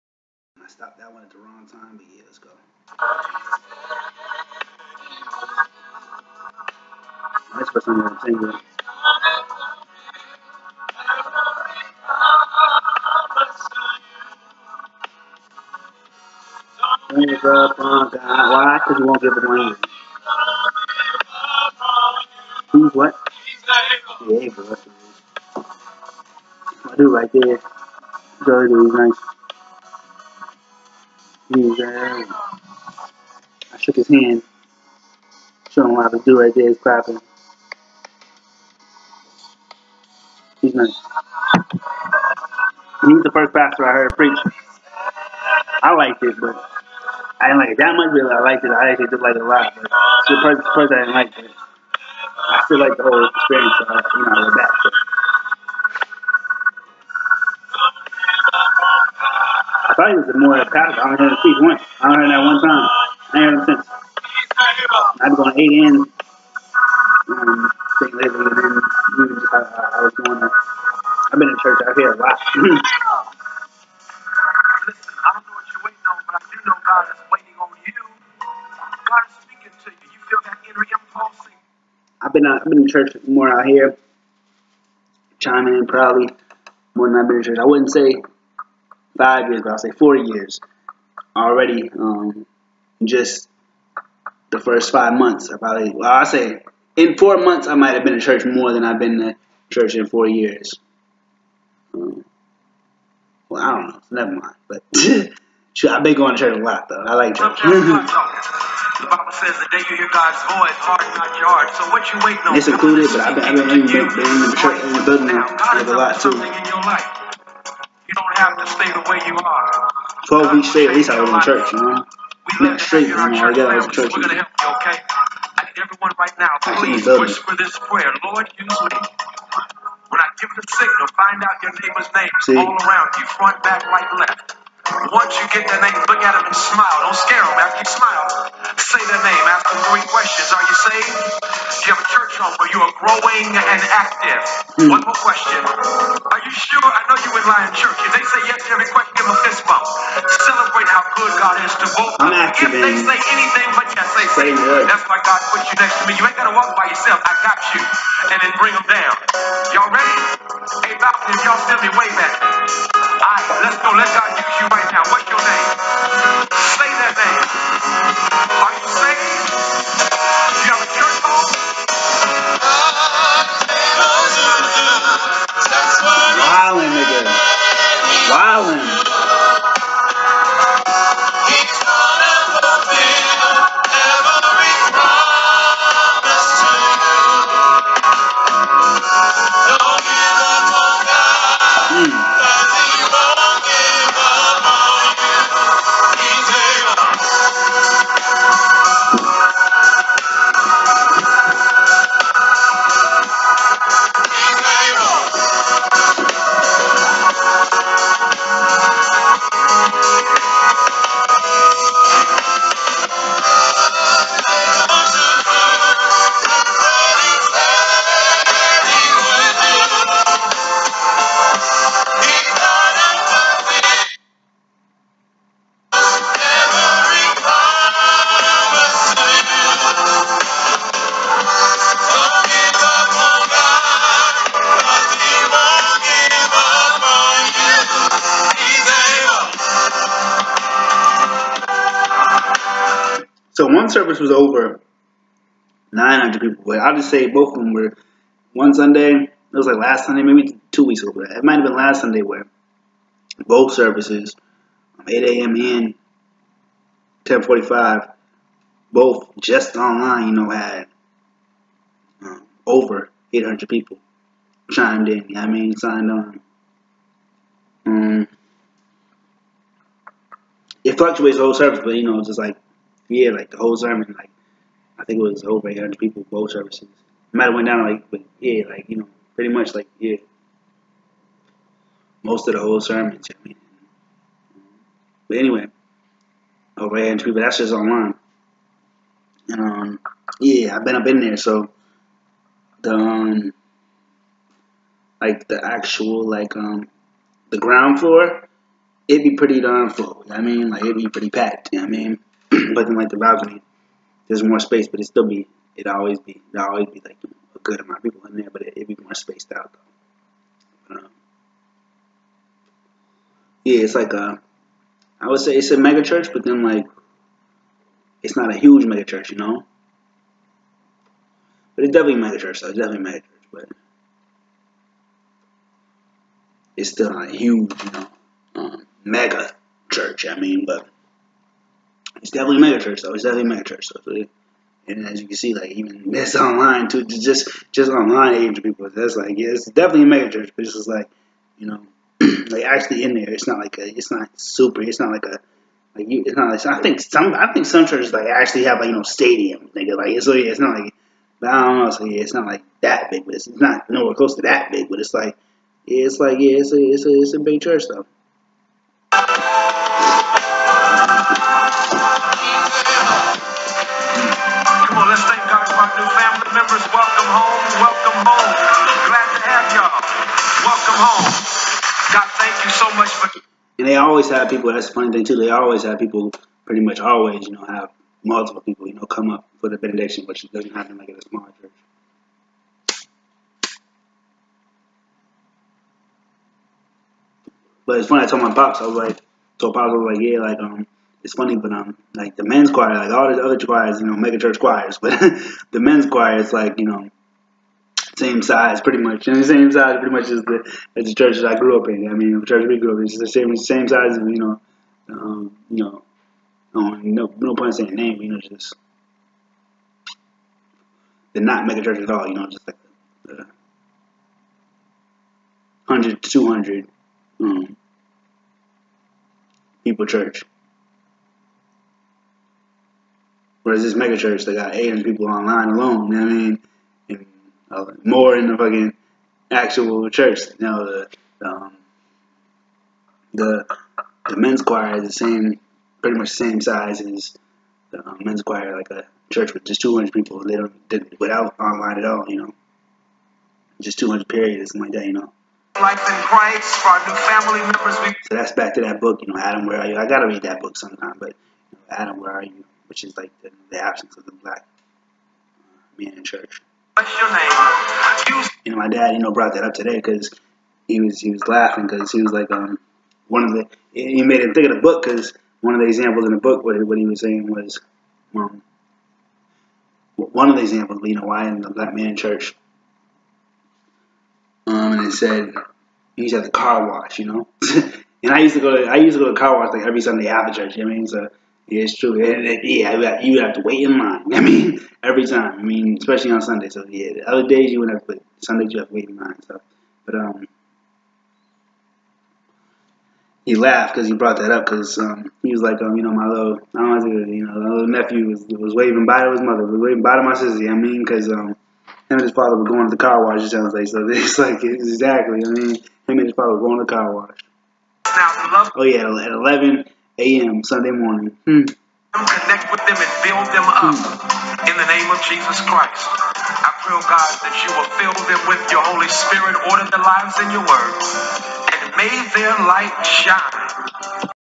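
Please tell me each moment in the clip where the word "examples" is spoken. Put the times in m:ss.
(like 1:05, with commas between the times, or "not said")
7:45, 7:50.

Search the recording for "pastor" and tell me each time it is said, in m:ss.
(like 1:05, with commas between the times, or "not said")
0:43.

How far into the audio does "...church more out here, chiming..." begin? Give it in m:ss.
1:22.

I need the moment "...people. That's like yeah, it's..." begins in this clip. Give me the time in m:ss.
5:38.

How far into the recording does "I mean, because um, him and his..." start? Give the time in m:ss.
8:20.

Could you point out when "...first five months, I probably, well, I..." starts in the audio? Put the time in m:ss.
1:34.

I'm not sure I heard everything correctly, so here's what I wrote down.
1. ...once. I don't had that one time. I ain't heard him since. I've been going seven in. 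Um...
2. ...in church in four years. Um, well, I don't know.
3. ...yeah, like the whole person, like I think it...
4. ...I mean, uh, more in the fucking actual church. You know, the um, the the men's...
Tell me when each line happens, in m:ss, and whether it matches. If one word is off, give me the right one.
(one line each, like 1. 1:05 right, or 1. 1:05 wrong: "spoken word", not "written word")
1. 1:01 wrong: "eight", not "seven"
2. 1:39 right
3. 4:33 wrong: "sermon", not "person"
4. 7:06 right.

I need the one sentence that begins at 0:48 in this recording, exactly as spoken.
I actually did like it a lot, but it's the first, first I didn't like it.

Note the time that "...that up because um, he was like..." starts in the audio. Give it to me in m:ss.
8:14.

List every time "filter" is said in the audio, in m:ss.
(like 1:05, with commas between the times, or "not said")
not said.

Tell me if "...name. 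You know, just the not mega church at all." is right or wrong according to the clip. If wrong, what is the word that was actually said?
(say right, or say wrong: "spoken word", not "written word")
right.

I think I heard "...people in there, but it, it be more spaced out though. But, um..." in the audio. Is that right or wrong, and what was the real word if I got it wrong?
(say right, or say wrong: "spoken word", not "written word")
right.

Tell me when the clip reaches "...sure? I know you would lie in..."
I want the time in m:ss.
2:26.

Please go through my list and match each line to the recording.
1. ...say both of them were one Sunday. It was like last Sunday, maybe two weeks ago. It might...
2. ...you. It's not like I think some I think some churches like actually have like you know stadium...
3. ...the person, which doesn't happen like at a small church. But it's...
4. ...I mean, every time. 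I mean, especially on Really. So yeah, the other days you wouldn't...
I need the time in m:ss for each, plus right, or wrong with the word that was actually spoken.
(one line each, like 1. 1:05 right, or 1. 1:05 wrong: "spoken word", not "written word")
1. 4:07 right
2. 5:46 right
3. 6:19 wrong: "benediction", not "person"
4. 8:04 wrong: "Sunday", not "Really".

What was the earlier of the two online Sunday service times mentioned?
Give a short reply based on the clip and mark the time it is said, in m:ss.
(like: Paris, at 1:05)
8 a.m., at 4:15.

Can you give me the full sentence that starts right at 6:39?
And the same size, pretty much, as the as the church that I grew up in.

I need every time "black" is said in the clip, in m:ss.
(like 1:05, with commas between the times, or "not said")
7:34, 7:51.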